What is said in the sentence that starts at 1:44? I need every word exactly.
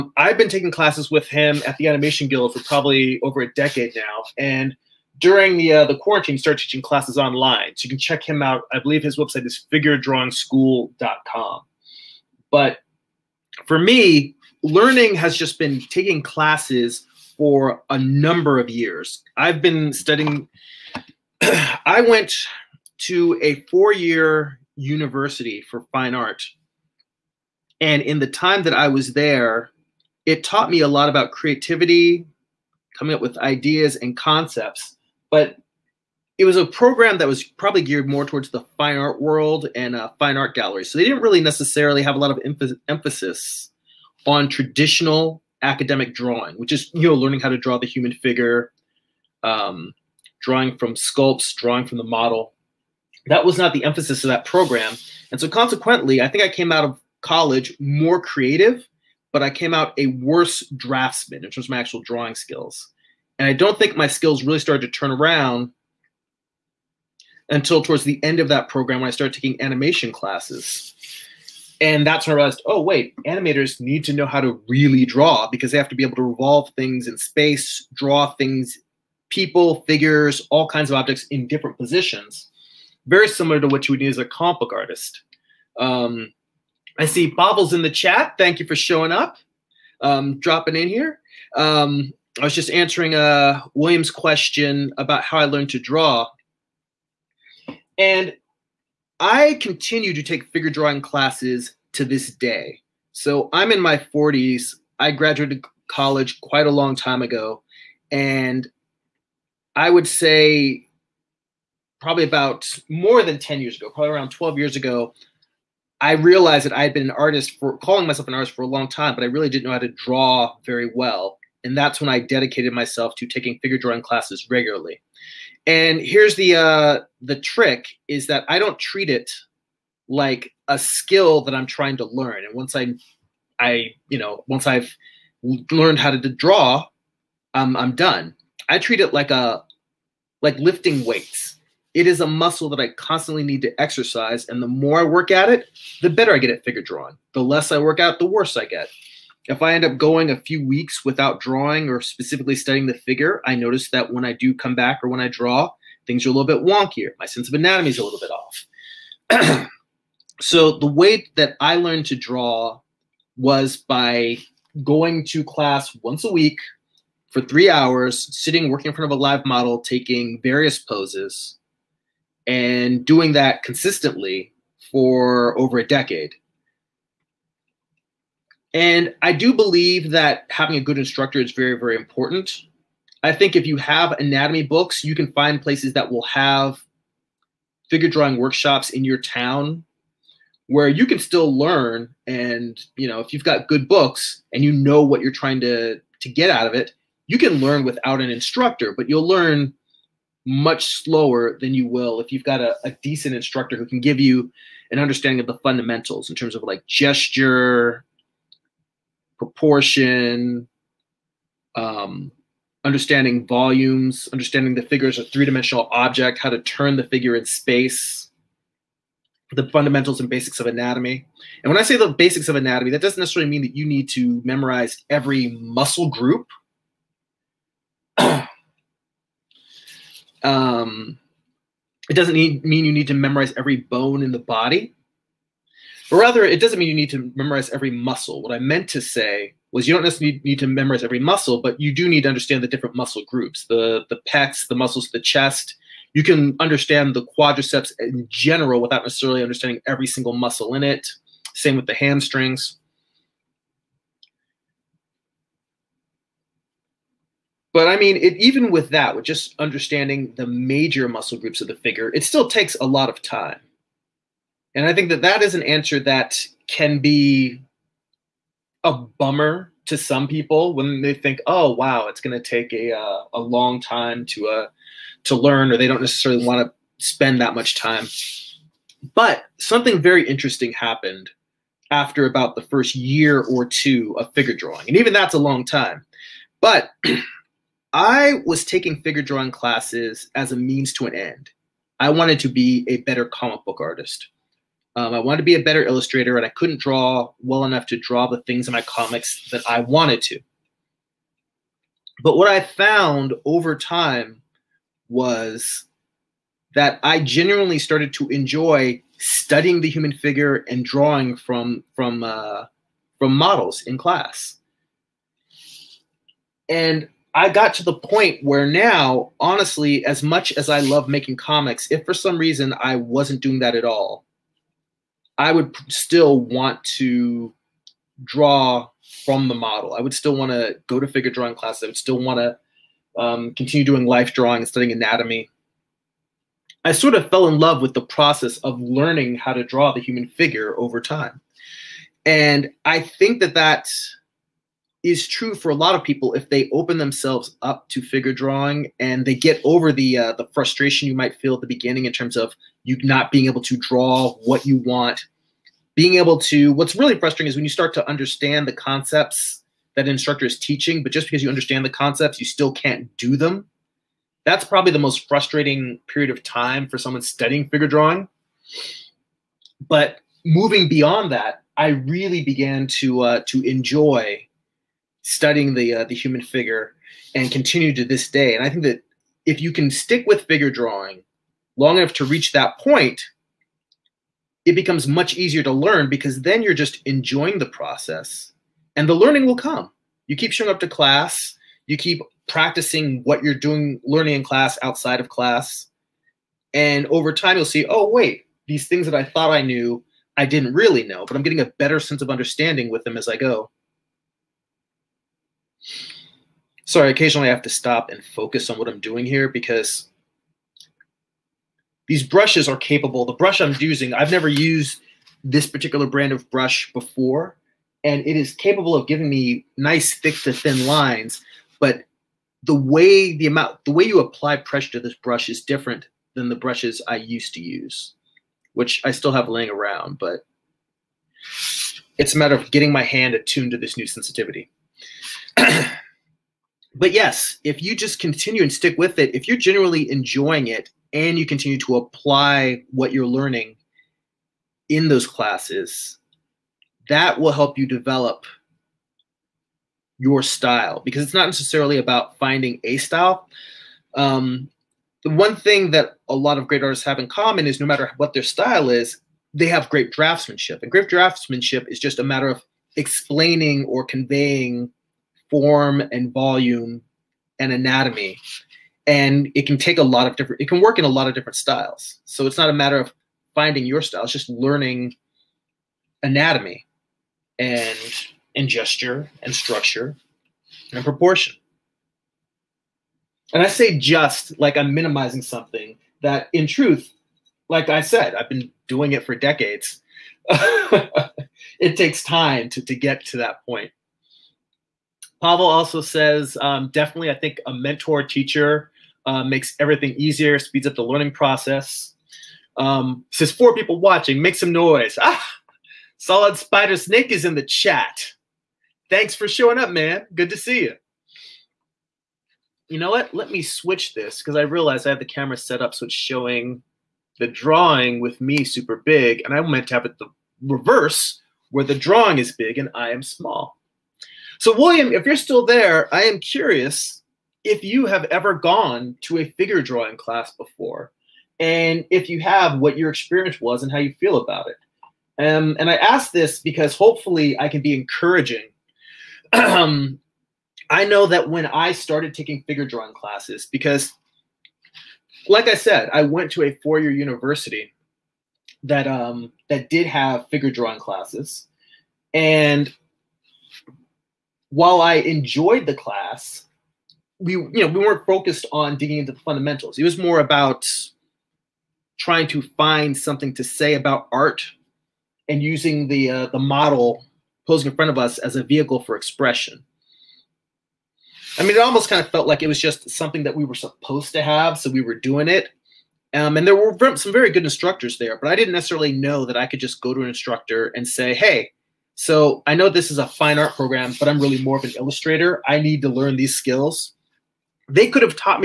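I graduated college quite a long time ago.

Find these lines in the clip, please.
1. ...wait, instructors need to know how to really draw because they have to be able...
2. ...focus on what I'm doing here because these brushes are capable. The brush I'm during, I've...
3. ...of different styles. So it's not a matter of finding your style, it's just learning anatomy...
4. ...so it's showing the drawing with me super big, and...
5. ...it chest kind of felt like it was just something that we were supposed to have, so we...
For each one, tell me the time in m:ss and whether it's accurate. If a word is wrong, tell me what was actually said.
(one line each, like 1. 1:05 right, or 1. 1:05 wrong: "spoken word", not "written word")
1. 1:12 wrong: "animators", not "instructors"
2. 6:48 wrong: "using", not "during"
3. 7:51 right
4. 8:35 right
5. 9:31 wrong: "almost", not "chest".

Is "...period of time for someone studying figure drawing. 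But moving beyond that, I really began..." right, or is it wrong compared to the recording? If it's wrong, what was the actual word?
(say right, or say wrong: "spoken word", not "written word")
right.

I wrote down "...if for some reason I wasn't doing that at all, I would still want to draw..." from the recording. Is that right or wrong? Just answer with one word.
right.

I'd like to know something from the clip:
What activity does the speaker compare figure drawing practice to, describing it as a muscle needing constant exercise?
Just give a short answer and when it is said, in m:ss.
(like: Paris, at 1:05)
lifting weights, at 2:20.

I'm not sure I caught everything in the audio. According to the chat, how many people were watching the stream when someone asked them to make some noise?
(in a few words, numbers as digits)
4.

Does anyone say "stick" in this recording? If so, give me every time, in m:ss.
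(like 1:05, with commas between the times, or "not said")
6:19, 7:18.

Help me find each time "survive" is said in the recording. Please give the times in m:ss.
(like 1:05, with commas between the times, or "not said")
not said.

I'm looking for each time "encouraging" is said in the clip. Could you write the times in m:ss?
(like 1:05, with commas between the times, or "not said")
8:57.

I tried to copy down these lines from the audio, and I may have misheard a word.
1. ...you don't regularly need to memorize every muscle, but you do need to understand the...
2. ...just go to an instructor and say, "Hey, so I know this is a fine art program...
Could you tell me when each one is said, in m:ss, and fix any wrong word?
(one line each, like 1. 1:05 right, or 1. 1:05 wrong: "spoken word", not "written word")
1. 3:59 wrong: "necessarily", not "regularly"
2. 9:39 right.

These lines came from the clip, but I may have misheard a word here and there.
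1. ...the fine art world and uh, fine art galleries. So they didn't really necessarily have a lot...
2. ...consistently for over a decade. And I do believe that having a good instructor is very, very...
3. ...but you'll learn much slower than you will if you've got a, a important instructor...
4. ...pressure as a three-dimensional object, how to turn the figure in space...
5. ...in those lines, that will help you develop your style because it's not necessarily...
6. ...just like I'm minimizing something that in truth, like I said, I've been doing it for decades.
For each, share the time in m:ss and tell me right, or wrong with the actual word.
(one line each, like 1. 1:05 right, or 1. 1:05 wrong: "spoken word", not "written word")
1. 0:38 right
2. 2:53 right
3. 3:18 wrong: "decent", not "important"
4. 3:34 wrong: "figure", not "pressure"
5. 7:24 wrong: "classes", not "lines"
6. 8:03 right.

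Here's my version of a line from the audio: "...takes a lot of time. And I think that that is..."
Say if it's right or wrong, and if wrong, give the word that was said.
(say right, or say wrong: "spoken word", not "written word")
right.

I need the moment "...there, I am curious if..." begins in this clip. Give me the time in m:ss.
8:45.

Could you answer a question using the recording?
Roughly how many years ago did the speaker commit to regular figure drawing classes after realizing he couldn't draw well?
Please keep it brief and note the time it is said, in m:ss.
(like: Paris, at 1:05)
12, at 1:54.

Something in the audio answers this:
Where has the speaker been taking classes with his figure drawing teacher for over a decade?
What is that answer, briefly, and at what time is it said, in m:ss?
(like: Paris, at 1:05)
Animation Guild, at 0:01.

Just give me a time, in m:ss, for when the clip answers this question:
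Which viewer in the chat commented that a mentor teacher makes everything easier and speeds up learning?
8:15.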